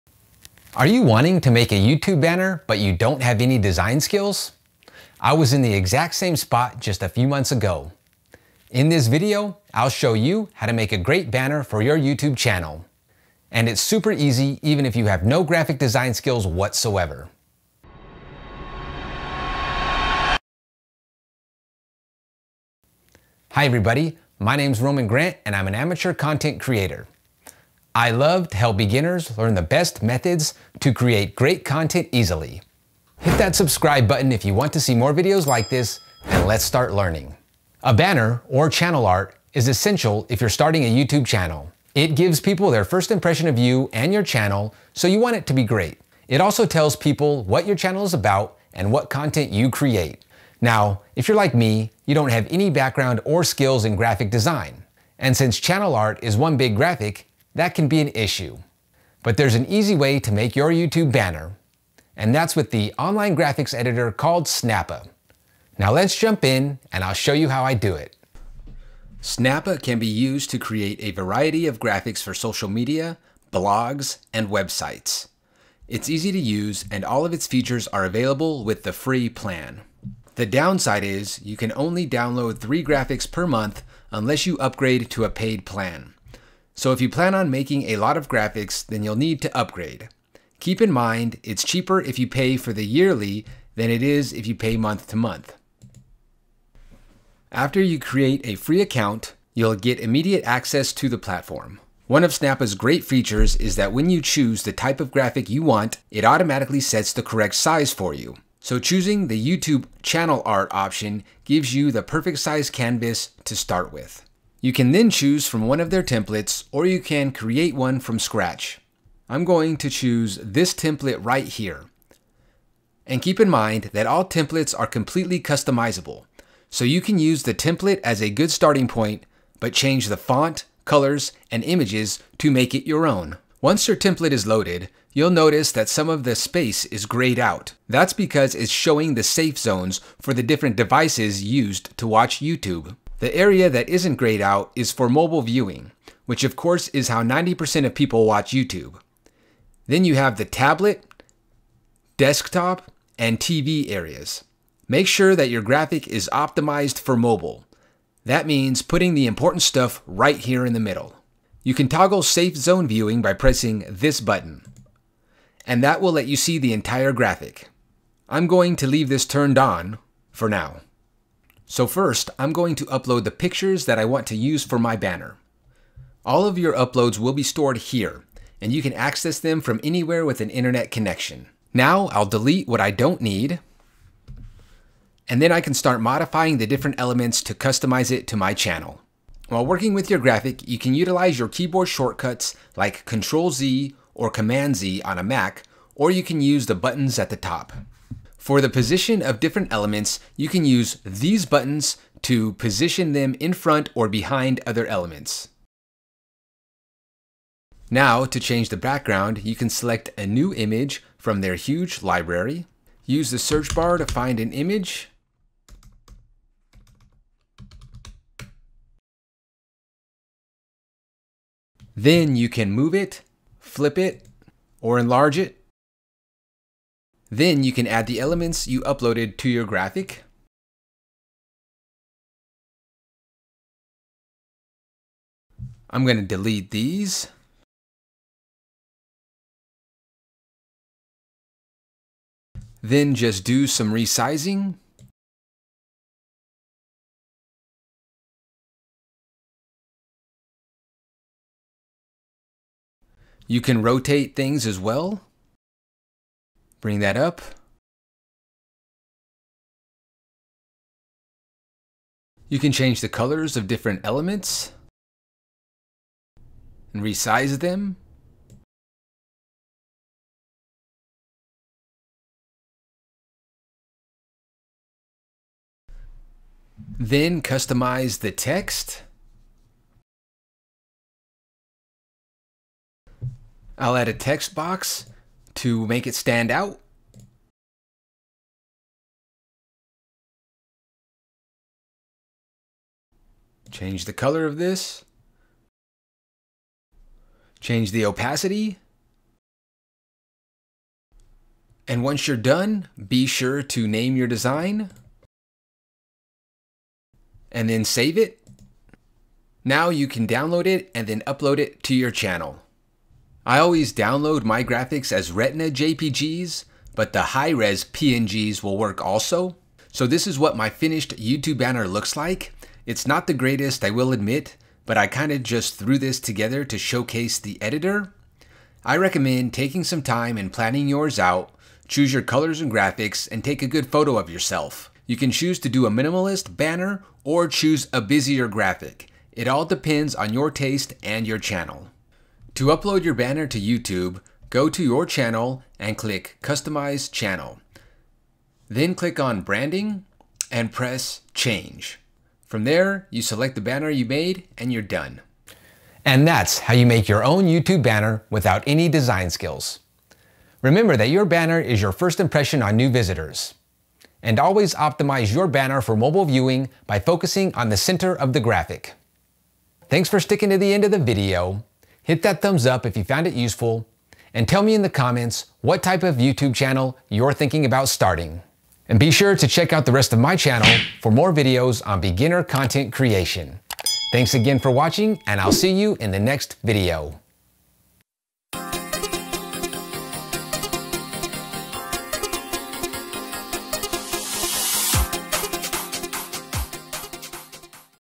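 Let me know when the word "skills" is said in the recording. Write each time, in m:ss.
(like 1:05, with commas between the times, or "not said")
0:03, 0:16, 0:53, 5:59.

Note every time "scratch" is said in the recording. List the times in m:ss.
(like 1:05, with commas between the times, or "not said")
1:58.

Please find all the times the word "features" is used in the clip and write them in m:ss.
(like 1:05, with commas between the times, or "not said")
1:17, 1:43.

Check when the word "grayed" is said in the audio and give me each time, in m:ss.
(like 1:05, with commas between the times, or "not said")
2:17, 2:24.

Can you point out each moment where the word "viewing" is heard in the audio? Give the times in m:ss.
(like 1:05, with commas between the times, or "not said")
2:25, 2:42, 6:06.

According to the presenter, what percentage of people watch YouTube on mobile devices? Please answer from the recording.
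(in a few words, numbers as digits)
90%.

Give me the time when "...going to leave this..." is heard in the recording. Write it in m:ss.
2:48.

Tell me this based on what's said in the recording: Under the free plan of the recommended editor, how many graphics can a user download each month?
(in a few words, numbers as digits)
3.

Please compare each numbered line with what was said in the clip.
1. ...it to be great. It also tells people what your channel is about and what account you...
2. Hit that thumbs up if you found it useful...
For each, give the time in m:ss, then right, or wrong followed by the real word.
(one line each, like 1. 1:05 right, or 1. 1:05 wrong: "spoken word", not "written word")
1. 0:45 wrong: "content", not "account"
2. 6:12 right.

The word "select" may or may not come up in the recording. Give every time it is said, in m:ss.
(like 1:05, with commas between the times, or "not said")
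3:29, 5:53.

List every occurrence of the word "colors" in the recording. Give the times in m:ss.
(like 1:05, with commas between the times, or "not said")
2:10, 4:23, 4:54, 5:32.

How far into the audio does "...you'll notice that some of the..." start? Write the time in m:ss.
2:15.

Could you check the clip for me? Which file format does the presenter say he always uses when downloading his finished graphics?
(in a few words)
Retina JPGs.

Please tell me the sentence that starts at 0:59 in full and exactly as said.
But there's an easy way to make your YouTube banner, and that's with the online graphics editor called Snappa.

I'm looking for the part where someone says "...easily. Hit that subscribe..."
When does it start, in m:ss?
0:32.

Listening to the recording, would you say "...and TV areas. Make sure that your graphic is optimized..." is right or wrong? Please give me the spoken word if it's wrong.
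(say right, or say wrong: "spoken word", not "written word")
right.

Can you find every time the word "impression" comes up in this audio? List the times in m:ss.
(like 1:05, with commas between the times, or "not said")
0:43, 6:02.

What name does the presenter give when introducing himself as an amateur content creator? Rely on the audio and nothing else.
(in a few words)
Roman Grant.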